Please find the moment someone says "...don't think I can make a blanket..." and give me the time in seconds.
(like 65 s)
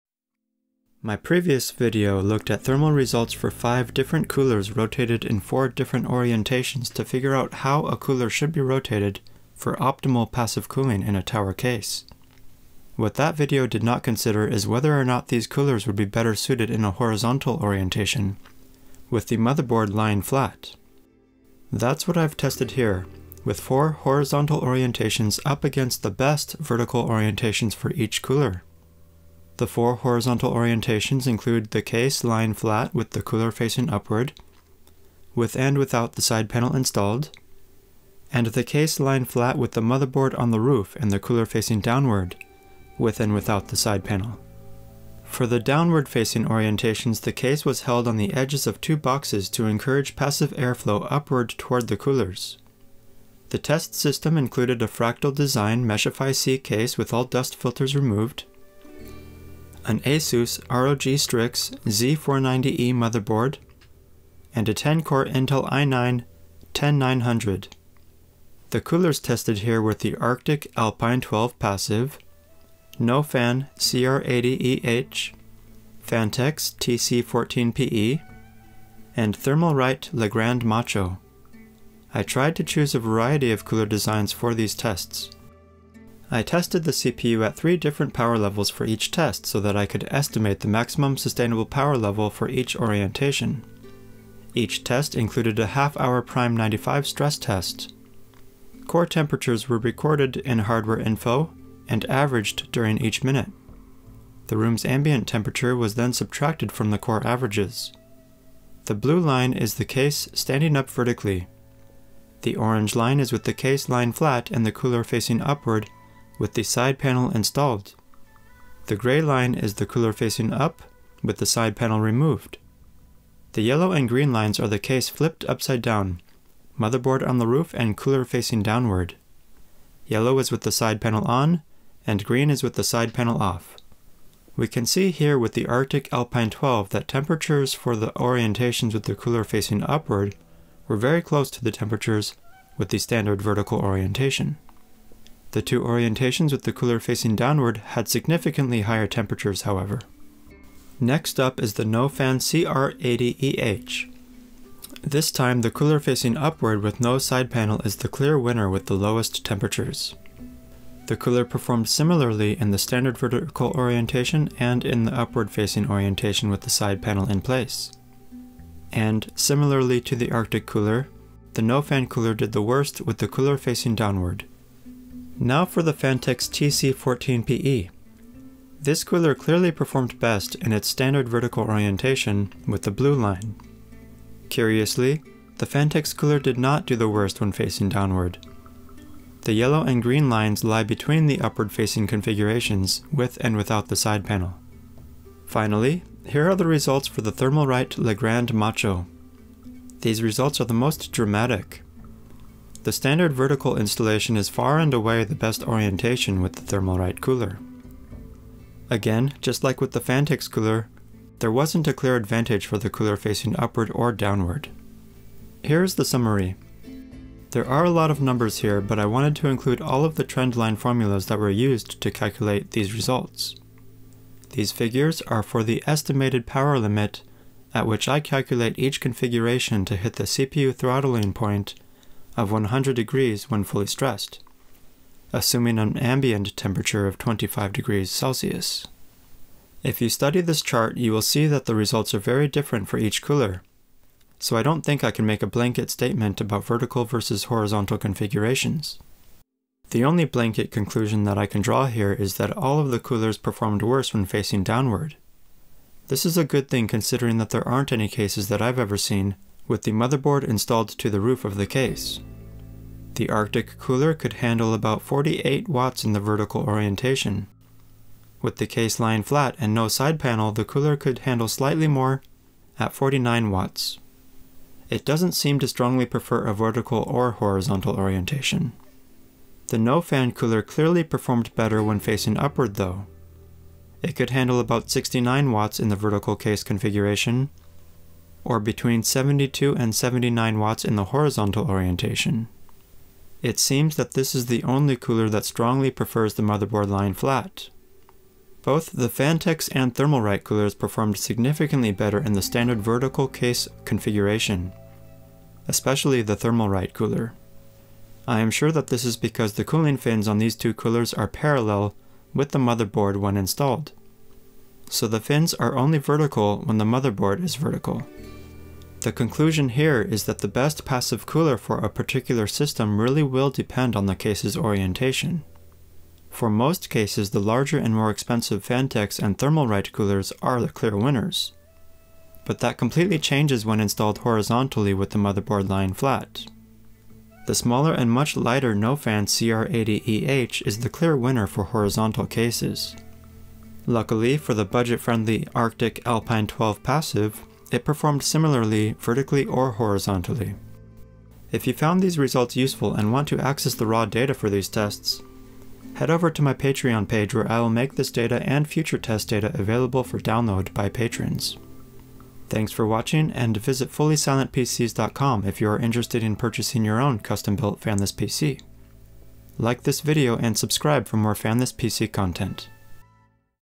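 244 s.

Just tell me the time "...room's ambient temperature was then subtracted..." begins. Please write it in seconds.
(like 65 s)
104 s.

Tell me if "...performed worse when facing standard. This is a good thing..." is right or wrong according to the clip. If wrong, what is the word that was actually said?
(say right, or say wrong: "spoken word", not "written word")
wrong: "downward", not "standard".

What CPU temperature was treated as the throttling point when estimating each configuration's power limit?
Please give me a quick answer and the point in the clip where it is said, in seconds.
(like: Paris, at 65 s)
100 degrees, at 232 s.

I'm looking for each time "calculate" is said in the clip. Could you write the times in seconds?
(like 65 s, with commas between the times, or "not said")
222 s, 228 s.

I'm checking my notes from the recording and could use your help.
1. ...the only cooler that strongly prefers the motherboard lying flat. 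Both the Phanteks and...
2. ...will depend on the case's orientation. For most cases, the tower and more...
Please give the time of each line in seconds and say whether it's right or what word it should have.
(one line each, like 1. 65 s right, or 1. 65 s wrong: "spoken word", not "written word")
1. 294 s right
2. 323 s wrong: "larger", not "tower".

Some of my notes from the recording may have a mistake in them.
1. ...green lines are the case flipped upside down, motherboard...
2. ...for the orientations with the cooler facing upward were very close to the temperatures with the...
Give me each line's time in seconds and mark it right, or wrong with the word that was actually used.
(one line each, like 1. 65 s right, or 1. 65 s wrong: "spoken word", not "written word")
1. 124 s right
2. 137 s right.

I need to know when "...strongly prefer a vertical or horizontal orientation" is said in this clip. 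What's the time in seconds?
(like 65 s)
275 s.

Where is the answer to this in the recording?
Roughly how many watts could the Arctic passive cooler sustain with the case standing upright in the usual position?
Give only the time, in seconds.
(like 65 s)
265 s.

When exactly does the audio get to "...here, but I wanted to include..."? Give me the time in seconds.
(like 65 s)
218 s.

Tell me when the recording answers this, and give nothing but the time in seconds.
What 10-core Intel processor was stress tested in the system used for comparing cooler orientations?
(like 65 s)
65 s.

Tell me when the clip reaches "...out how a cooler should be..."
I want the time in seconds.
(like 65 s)
7 s.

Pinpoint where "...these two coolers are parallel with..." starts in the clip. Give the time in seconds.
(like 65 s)
310 s.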